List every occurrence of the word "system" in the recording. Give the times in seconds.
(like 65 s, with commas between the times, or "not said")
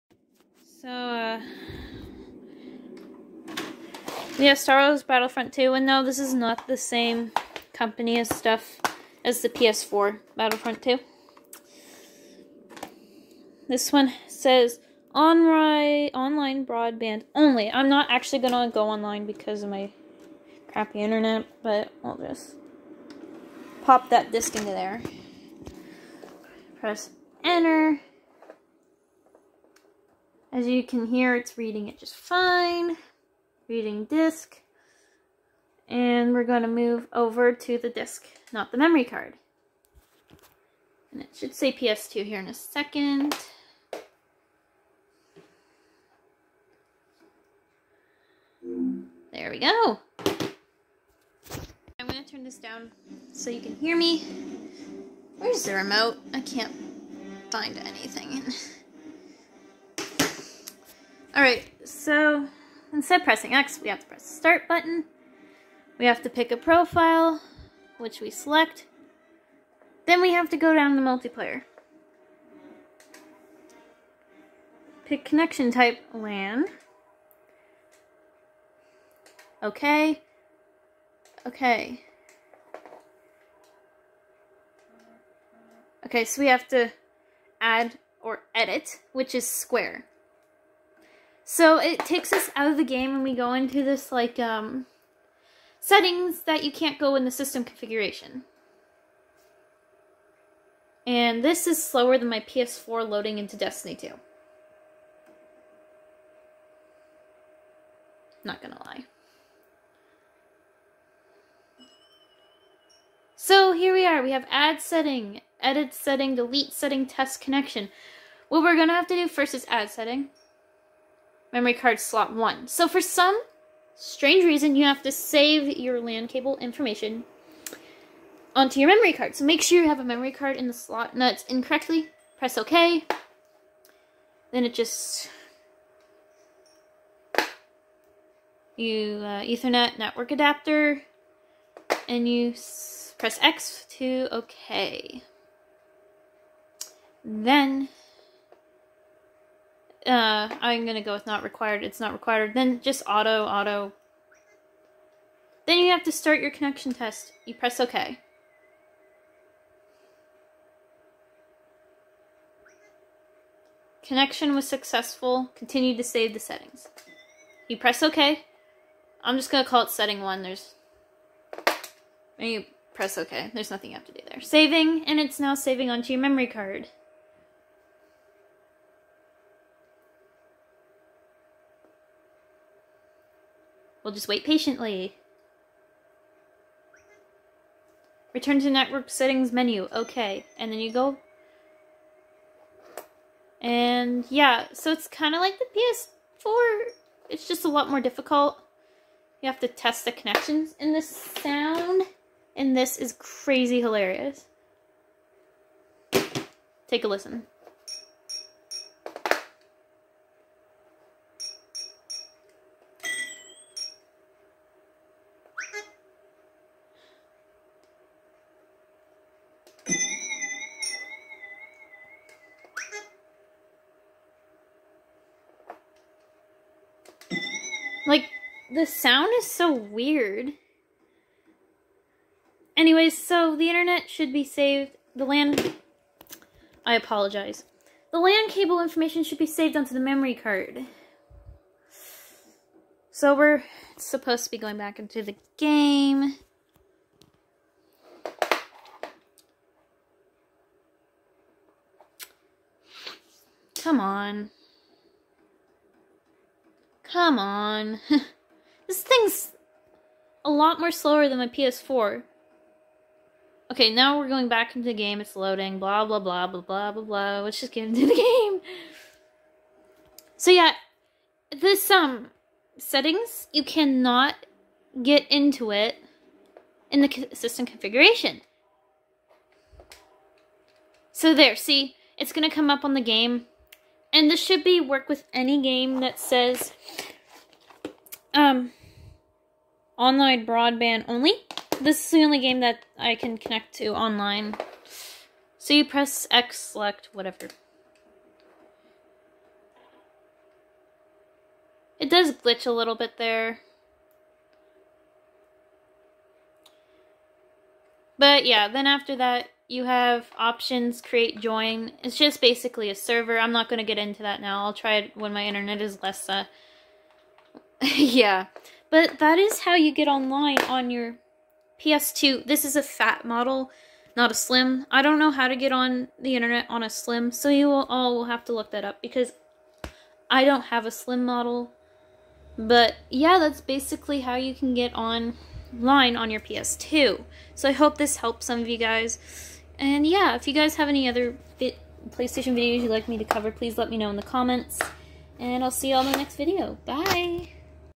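97 s, 277 s.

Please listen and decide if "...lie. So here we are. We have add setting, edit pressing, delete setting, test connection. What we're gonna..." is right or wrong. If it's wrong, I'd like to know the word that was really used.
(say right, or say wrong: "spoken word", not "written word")
wrong: "setting", not "pressing".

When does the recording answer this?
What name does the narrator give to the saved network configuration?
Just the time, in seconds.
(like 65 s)
169 s.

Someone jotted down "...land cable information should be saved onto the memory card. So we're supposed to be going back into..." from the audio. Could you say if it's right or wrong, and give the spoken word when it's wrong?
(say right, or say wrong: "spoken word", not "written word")
right.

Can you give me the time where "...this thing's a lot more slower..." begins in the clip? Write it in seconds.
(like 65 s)
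258 s.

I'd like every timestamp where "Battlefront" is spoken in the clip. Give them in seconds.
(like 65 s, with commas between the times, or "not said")
5 s, 10 s.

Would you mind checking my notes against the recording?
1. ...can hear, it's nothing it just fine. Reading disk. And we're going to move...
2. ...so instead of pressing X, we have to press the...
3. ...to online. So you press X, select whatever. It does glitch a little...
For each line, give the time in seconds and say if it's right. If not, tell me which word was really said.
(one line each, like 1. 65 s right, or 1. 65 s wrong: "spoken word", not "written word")
1. 30 s wrong: "reading", not "nothing"
2. 61 s right
3. 293 s right.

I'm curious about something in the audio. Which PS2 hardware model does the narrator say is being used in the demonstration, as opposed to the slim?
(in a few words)
Fat model.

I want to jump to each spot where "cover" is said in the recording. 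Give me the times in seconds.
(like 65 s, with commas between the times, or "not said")
343 s.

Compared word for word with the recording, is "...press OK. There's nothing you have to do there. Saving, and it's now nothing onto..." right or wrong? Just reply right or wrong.
wrong.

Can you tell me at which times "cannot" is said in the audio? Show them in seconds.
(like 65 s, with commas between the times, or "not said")
273 s.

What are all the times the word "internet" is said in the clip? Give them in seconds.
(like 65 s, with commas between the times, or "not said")
21 s, 233 s, 315 s, 326 s.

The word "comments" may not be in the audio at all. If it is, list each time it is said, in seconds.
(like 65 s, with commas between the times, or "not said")
344 s.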